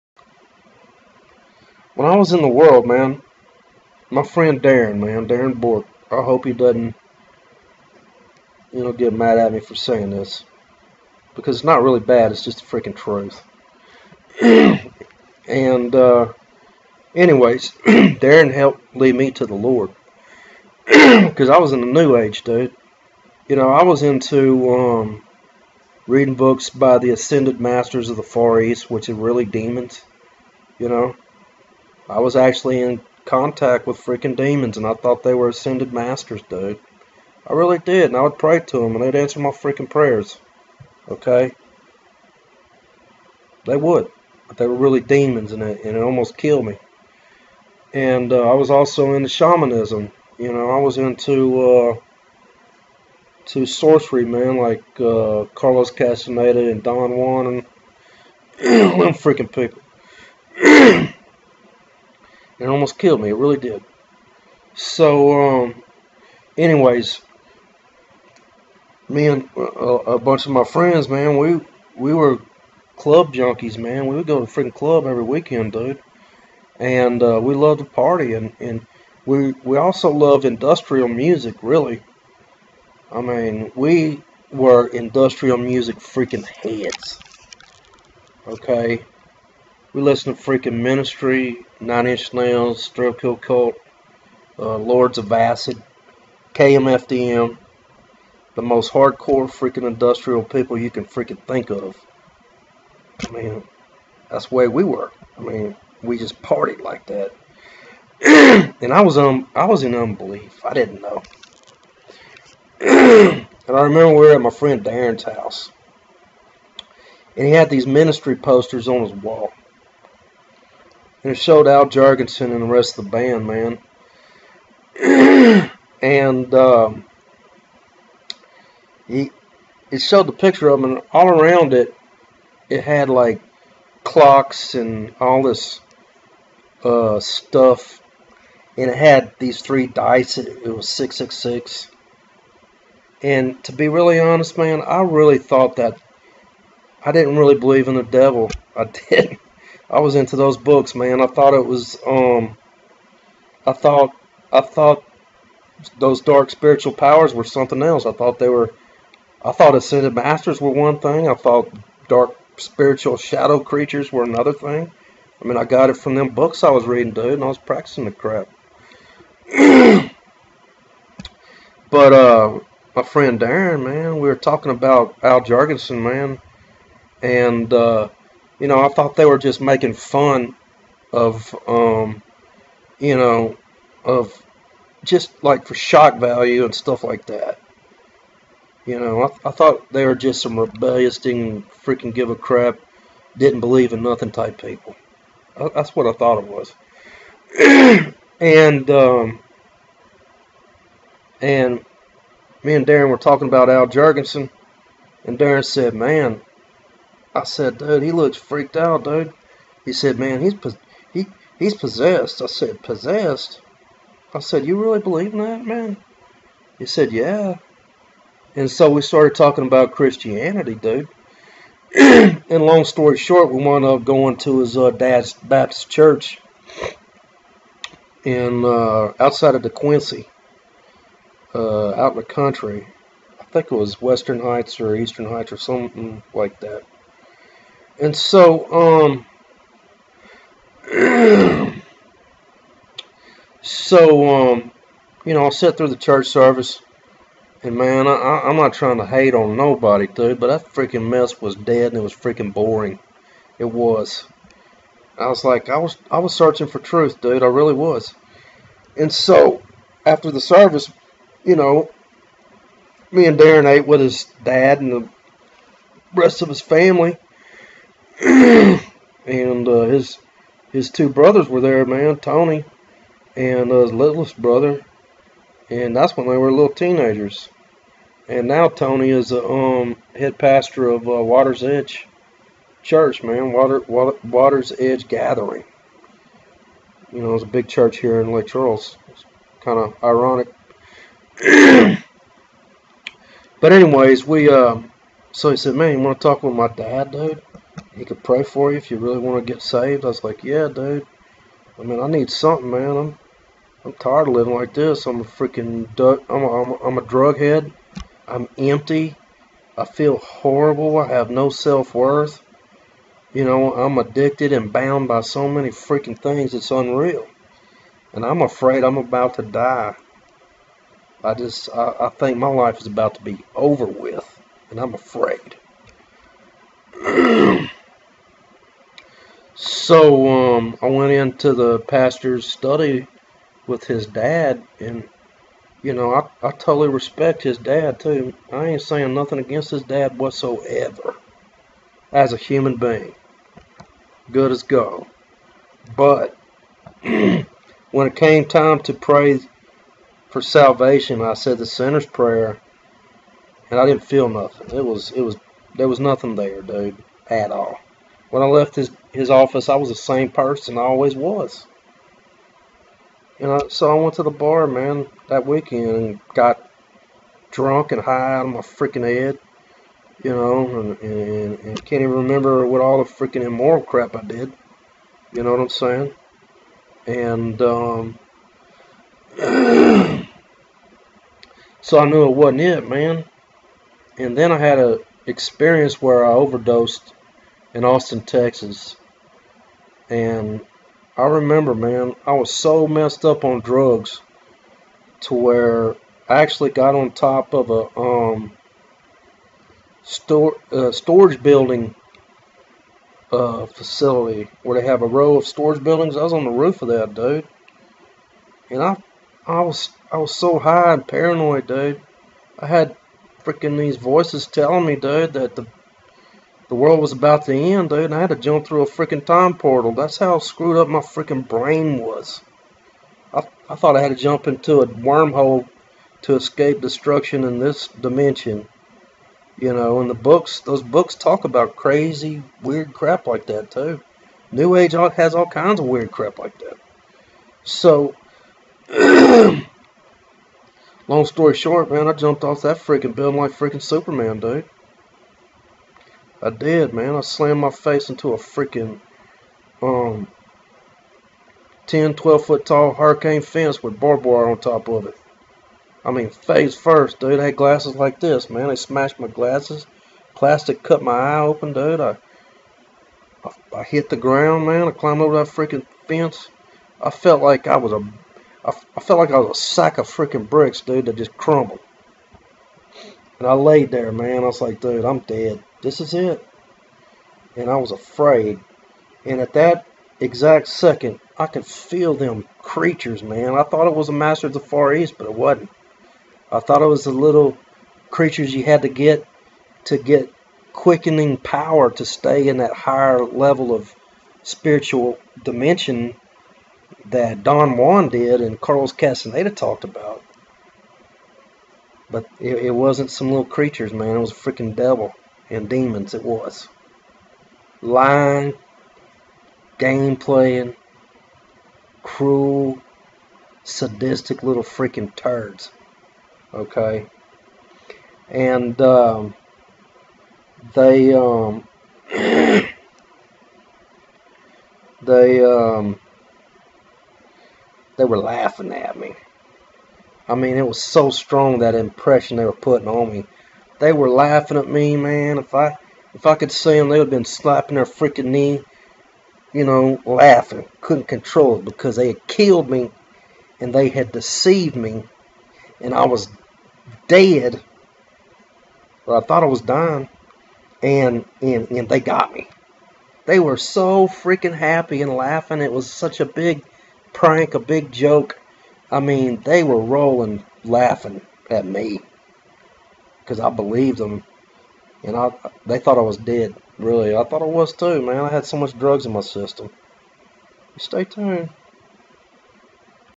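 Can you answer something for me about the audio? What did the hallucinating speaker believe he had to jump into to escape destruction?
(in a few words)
a wormhole.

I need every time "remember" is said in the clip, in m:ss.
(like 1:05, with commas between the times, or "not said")
1:53, 6:12, 6:31.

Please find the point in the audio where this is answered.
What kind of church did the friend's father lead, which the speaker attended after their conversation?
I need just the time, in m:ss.
3:45.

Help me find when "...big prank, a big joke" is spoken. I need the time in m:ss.
9:16.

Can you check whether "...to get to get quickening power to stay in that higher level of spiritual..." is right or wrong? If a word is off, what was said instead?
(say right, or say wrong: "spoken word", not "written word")
right.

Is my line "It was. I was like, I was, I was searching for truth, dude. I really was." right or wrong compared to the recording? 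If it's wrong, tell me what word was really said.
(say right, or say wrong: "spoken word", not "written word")
right.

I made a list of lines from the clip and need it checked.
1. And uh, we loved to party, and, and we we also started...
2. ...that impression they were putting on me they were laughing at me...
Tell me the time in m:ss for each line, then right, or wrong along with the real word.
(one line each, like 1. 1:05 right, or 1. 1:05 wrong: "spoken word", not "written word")
1. 1:16 wrong: "loved", not "started"
2. 8:51 right.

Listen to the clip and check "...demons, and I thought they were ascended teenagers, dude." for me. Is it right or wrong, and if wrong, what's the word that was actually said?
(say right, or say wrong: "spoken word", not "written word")
wrong: "masters", not "teenagers".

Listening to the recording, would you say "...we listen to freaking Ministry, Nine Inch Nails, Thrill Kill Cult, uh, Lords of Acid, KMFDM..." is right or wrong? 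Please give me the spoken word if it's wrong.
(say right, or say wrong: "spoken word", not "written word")
right.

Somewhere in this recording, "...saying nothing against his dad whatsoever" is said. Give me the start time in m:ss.
5:38.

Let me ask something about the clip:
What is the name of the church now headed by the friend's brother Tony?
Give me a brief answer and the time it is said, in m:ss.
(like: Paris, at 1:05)
Water's Edge Gathering, at 4:44.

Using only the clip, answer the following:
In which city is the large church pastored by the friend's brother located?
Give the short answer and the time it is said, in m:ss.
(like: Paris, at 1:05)
Lake Charles, at 4:48.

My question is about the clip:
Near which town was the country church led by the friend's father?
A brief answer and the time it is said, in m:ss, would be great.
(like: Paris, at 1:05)
De Quincy, at 3:49.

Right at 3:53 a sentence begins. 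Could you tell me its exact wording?
I think it was Western Heights or Eastern Heights or something like that.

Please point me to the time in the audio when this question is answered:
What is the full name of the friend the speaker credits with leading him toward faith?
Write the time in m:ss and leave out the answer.
0:05.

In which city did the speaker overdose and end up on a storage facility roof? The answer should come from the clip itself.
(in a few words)
Austin, Texas.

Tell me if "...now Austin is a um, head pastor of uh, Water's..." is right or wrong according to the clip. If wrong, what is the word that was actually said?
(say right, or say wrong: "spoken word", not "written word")
wrong: "Tony", not "Austin".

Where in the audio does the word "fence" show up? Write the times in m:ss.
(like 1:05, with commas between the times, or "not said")
7:33, 7:46.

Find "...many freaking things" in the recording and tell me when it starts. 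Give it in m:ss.
5:15.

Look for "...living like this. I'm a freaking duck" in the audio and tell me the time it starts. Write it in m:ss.
5:04.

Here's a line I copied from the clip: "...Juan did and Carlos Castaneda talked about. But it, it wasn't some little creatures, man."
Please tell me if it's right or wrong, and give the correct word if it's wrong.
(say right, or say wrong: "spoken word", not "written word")
right.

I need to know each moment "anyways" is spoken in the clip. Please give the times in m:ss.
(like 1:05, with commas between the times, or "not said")
0:17, 1:06, 4:53.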